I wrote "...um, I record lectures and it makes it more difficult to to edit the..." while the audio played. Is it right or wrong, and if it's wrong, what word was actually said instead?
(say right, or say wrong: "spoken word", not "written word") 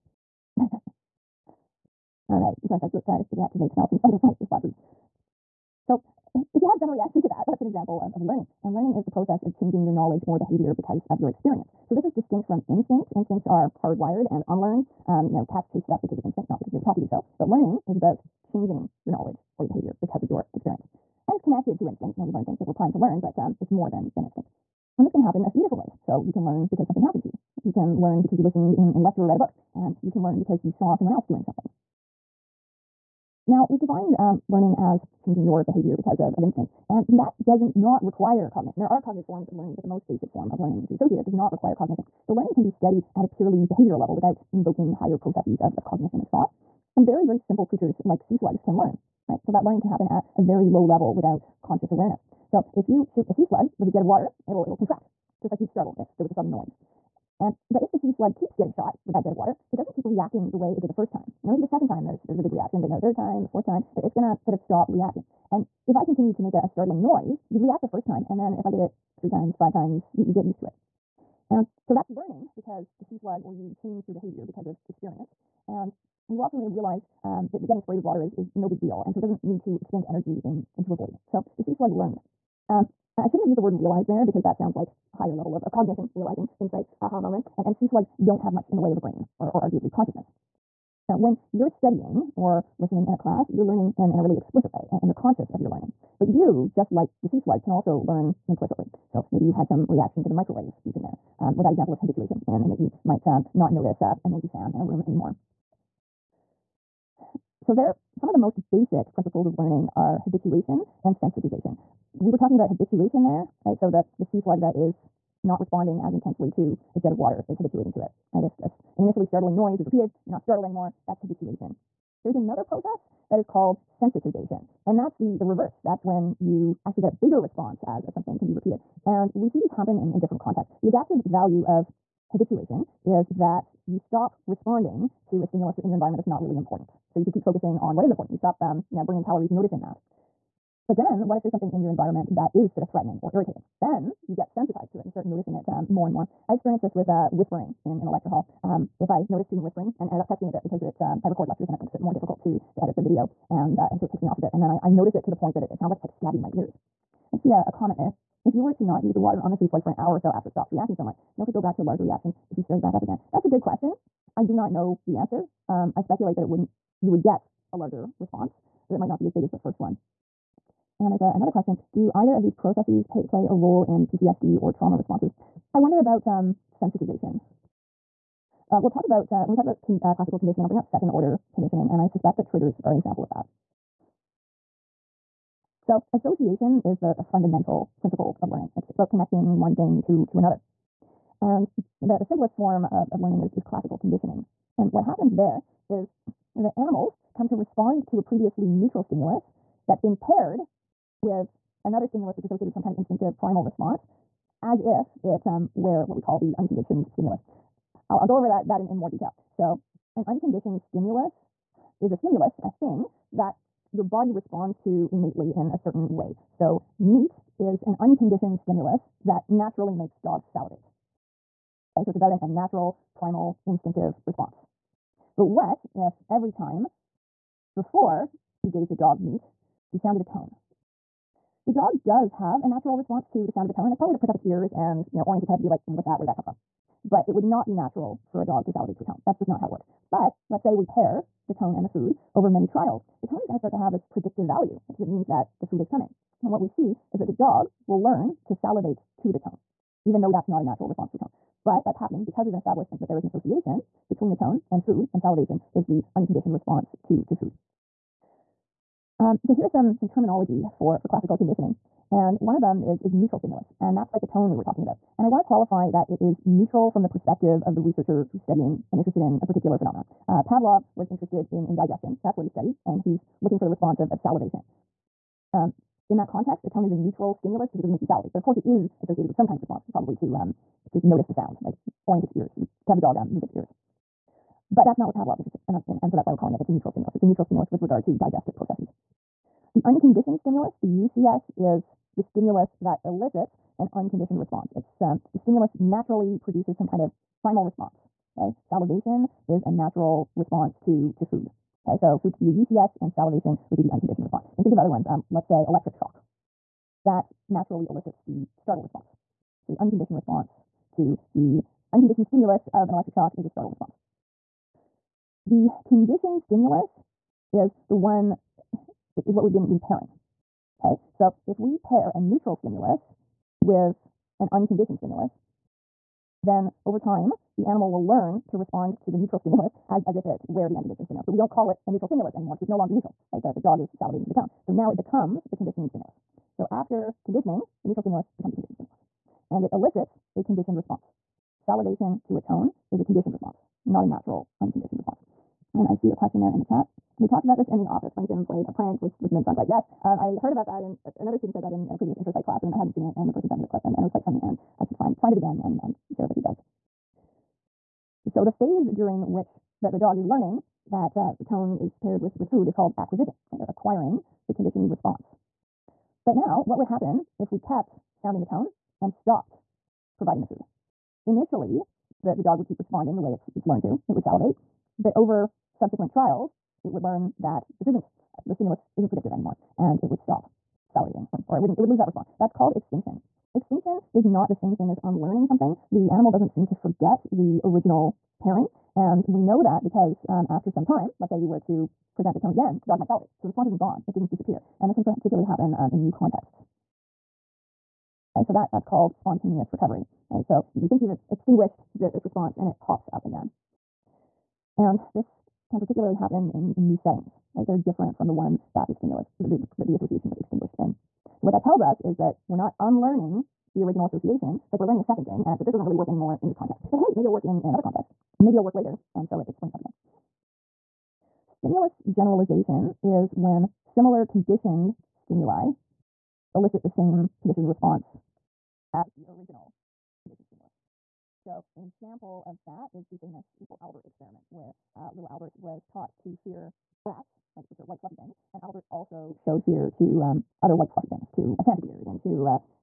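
right.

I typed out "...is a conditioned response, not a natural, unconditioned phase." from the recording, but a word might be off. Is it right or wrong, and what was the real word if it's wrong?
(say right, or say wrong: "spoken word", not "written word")
wrong: "response", not "phase".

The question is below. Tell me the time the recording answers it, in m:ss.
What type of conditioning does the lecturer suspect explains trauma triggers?
3:00.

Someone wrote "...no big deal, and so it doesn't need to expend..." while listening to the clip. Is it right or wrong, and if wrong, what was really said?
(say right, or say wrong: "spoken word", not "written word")
right.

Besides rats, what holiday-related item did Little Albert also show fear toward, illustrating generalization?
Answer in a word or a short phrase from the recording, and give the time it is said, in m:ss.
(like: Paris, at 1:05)
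a Santa beard, at 7:21.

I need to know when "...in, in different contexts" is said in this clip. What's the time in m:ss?
2:09.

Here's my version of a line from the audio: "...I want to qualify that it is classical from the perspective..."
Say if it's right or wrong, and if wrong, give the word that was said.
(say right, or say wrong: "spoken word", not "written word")
wrong: "neutral", not "classical".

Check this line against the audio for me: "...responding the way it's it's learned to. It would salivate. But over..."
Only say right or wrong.
right.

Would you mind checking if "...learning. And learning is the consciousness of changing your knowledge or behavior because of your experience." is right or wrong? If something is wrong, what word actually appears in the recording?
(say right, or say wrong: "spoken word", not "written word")
wrong: "process", not "consciousness".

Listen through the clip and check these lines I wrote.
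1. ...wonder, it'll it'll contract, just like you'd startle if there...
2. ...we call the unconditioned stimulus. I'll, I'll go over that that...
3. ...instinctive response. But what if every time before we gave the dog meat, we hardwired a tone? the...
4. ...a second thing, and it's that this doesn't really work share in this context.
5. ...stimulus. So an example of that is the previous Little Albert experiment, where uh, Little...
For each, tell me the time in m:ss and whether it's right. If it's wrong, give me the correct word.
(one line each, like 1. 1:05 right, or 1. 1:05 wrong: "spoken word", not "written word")
1. 0:54 wrong: "water", not "wonder"
2. 3:26 right
3. 3:43 wrong: "sounded", not "hardwired"
4. 6:55 wrong: "anymore", not "share"
5. 7:10 wrong: "famous", not "previous".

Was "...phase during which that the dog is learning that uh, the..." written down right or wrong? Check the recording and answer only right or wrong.
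right.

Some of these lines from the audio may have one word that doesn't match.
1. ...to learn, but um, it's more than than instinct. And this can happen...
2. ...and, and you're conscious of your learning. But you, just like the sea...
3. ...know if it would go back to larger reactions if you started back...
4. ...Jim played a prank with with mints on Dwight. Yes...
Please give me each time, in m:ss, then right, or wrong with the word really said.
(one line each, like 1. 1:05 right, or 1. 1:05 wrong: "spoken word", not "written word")
1. 0:22 right
2. 1:34 right
3. 2:41 right
4. 5:48 right.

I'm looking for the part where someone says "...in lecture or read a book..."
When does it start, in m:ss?
0:28.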